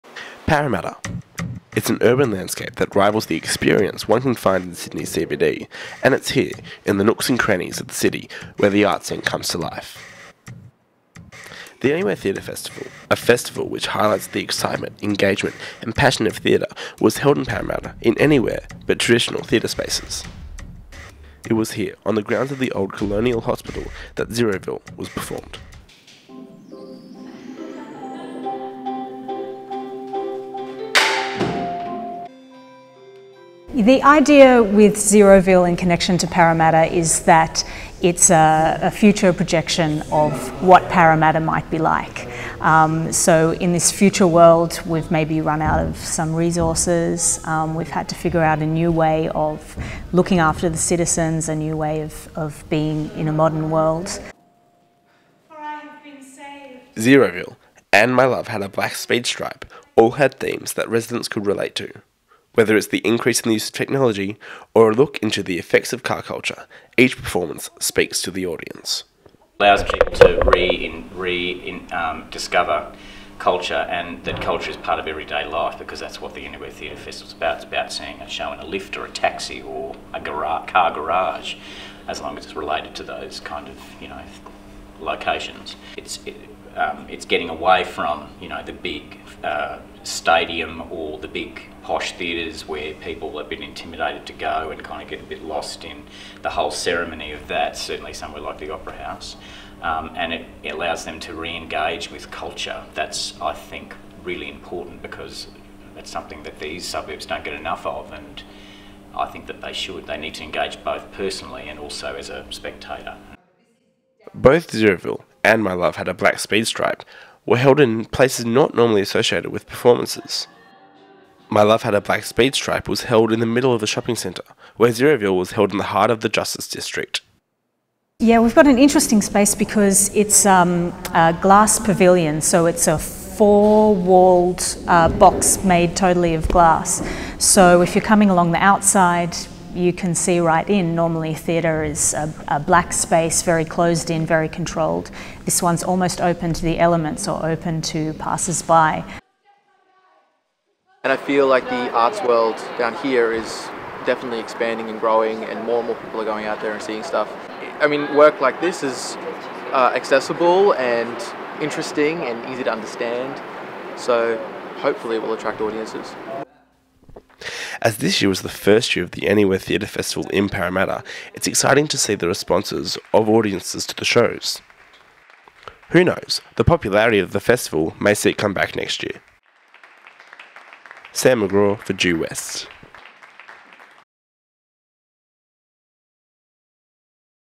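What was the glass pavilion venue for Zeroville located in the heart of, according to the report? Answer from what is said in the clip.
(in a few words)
the Justice District.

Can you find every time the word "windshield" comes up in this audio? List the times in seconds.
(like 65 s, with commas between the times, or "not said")
not said.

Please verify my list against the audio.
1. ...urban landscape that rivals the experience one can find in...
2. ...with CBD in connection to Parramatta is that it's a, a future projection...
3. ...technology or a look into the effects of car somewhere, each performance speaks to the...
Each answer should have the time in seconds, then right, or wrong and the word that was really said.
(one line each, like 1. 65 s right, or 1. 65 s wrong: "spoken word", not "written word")
1. 2 s right
2. 34 s wrong: "Zeroville", not "CBD"
3. 63 s wrong: "culture", not "somewhere".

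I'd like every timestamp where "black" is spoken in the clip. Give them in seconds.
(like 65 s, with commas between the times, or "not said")
58 s, 116 s, 122 s, 142 s.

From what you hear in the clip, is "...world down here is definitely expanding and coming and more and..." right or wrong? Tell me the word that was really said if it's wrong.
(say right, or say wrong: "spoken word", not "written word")
wrong: "growing", not "coming".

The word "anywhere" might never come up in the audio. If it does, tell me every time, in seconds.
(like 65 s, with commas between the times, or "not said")
11 s, 18 s, 76 s, 169 s.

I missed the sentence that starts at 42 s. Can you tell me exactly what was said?
Um, so in this future world, we've maybe run out of some resources.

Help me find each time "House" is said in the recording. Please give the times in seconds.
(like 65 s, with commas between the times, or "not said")
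98 s.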